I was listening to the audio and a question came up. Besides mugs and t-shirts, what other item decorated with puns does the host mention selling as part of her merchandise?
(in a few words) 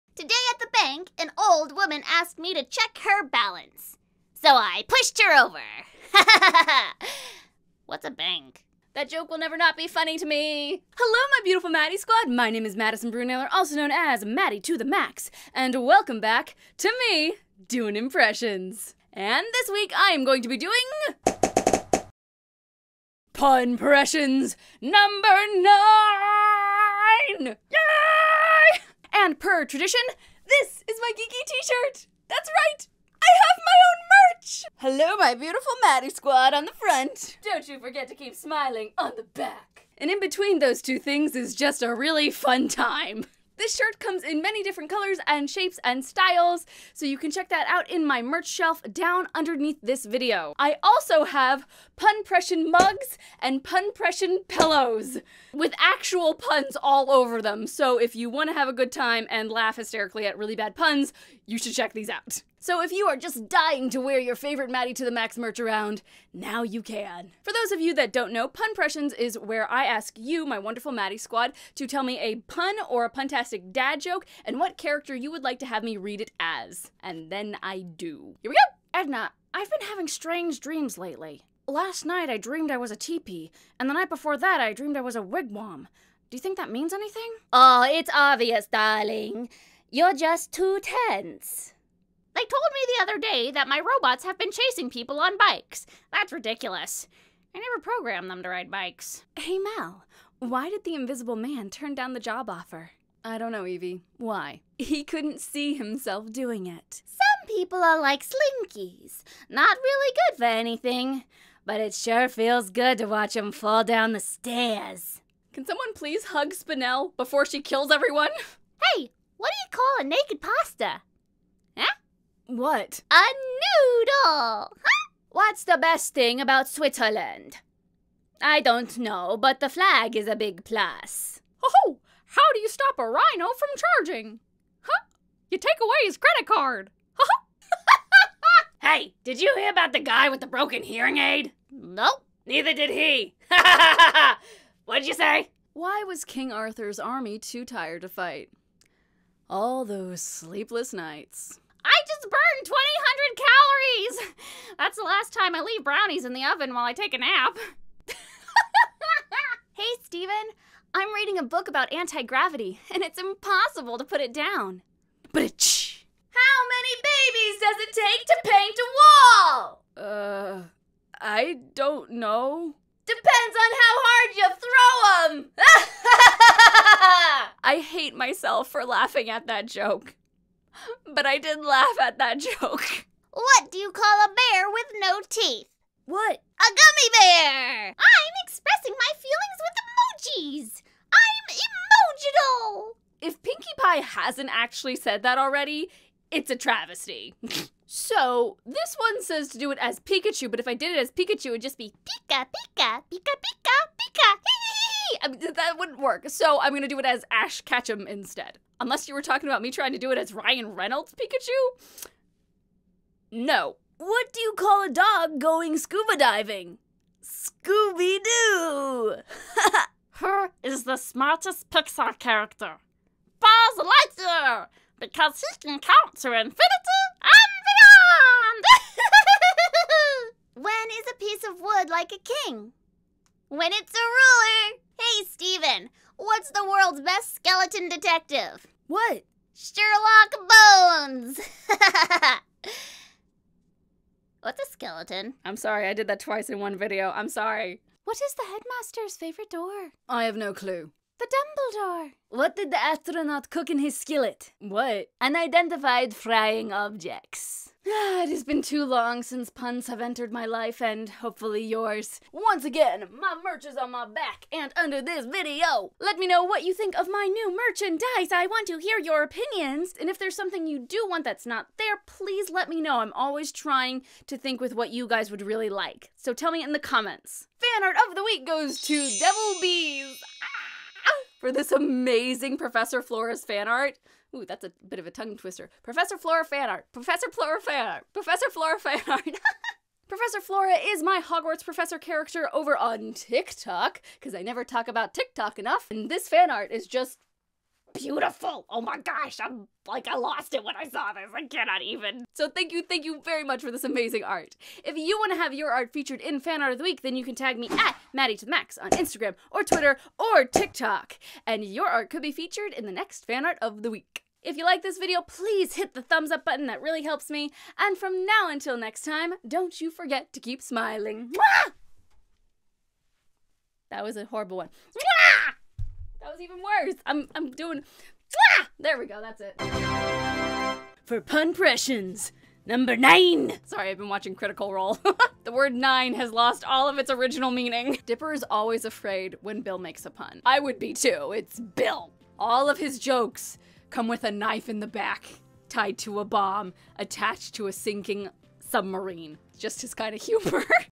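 Pillows.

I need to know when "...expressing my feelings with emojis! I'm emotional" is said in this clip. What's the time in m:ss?
3:08.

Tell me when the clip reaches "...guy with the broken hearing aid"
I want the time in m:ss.
2:20.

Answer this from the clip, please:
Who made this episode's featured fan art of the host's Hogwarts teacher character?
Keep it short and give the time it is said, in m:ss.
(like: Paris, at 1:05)
Devil Bees, at 4:39.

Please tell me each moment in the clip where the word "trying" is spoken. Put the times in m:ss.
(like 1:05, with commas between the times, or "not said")
3:29, 4:33.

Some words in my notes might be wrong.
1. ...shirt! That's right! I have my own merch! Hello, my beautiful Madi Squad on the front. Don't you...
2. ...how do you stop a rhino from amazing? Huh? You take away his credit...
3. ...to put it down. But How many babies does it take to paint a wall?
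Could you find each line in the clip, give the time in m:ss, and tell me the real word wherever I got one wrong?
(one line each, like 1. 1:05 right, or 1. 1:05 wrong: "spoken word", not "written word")
1. 0:31 right
2. 2:12 wrong: "charging", not "amazing"
3. 2:43 right.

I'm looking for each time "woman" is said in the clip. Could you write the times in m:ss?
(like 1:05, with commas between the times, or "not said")
0:01.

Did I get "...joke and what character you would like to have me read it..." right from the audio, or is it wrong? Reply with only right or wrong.
right.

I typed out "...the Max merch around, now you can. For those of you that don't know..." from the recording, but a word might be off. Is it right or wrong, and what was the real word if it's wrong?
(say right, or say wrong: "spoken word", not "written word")
right.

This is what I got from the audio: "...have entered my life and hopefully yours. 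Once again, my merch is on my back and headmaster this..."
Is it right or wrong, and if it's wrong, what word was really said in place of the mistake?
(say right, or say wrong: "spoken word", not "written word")
wrong: "under", not "headmaster".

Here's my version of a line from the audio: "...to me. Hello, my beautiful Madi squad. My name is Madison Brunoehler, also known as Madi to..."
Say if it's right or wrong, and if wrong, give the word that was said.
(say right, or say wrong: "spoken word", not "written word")
right.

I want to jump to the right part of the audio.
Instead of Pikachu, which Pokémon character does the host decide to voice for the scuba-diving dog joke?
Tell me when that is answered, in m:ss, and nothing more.
3:27.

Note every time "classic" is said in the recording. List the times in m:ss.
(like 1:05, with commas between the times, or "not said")
not said.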